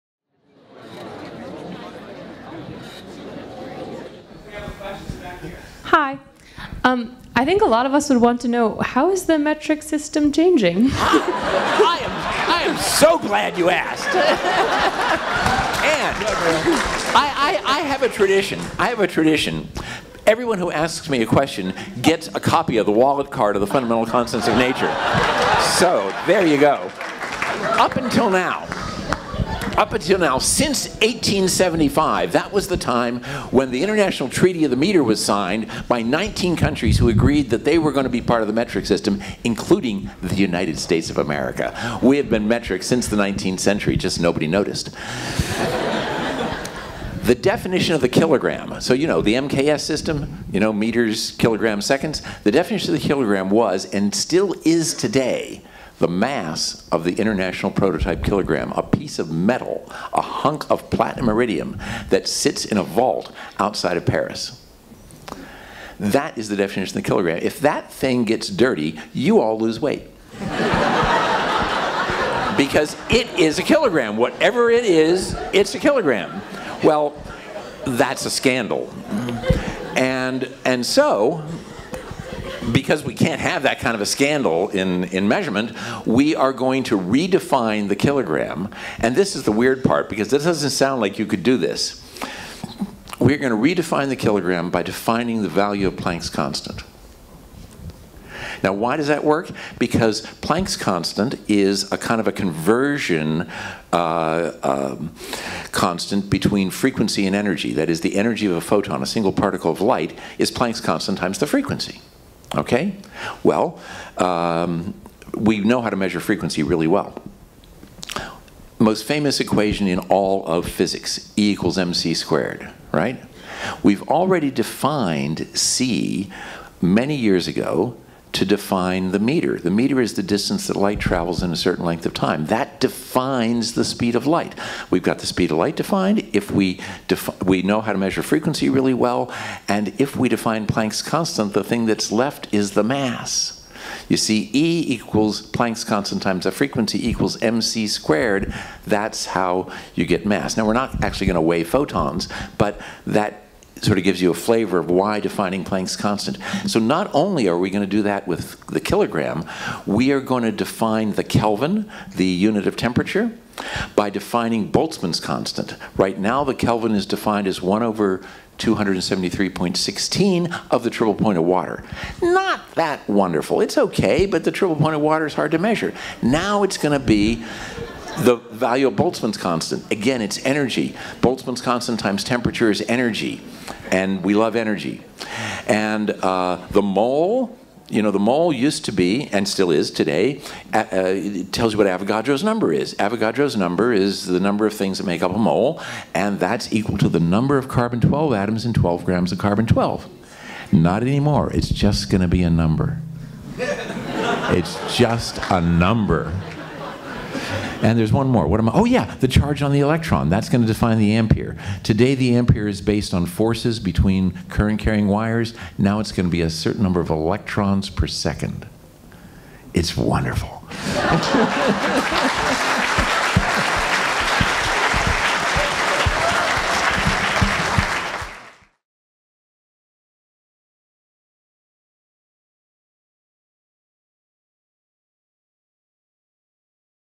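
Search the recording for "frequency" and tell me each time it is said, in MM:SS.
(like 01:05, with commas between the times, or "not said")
01:46, 01:51, 01:56, 02:18, 02:26.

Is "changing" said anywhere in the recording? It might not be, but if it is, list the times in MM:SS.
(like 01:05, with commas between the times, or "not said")
00:10.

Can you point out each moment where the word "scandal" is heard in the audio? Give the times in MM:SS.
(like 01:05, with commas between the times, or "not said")
01:18, 01:24.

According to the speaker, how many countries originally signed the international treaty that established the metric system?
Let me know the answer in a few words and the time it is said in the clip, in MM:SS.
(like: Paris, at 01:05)
19, at 00:36.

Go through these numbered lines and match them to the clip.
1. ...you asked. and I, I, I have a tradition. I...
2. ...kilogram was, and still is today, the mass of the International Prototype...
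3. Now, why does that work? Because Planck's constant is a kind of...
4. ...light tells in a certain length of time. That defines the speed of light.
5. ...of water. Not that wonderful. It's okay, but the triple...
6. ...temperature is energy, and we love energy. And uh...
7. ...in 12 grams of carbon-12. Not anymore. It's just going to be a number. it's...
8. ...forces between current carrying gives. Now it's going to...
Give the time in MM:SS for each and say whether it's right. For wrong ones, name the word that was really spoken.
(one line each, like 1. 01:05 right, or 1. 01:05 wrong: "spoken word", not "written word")
1. 00:13 right
2. 00:53 right
3. 01:38 right
4. 02:10 wrong: "travels", not "tells"
5. 02:51 right
6. 03:02 right
7. 03:18 right
8. 03:33 wrong: "wires", not "gives".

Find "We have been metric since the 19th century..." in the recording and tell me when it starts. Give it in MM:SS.
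00:42.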